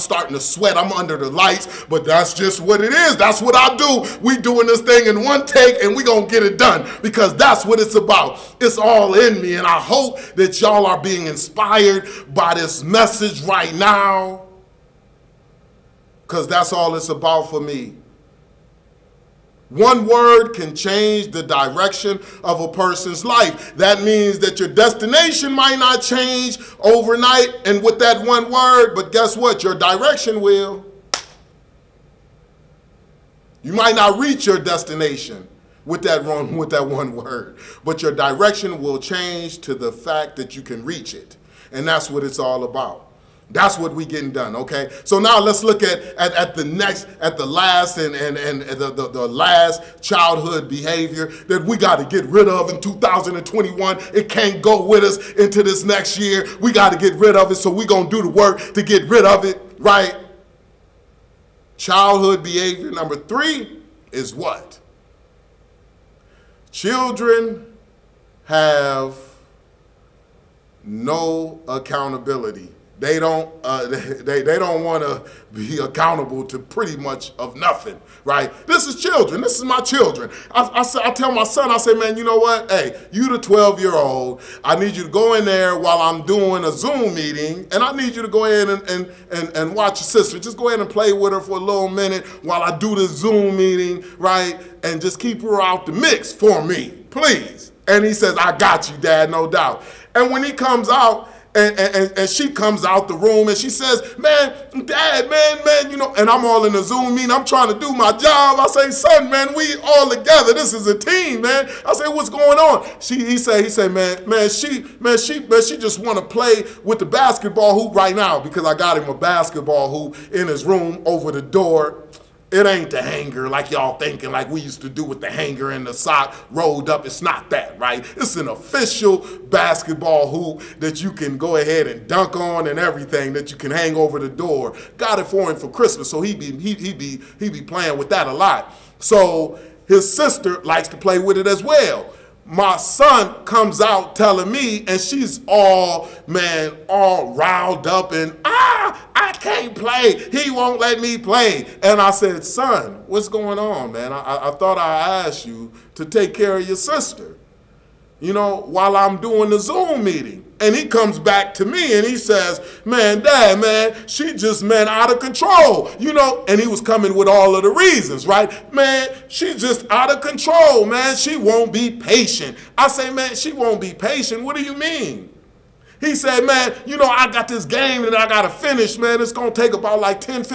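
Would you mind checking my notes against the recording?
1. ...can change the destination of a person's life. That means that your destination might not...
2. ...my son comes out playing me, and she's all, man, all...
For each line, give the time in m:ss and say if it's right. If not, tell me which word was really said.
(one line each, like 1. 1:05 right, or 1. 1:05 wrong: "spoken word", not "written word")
1. 0:20 wrong: "direction", not "destination"
2. 2:22 wrong: "telling", not "playing".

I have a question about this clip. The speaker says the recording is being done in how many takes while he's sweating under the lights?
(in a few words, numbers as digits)
1 take.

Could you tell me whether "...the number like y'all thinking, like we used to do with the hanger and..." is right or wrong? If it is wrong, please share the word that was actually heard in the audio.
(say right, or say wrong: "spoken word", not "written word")
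wrong: "hanger", not "number".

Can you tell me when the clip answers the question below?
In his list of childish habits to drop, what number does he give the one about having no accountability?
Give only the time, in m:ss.
1:03.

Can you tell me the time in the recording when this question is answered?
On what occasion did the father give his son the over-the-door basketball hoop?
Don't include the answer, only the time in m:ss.
2:15.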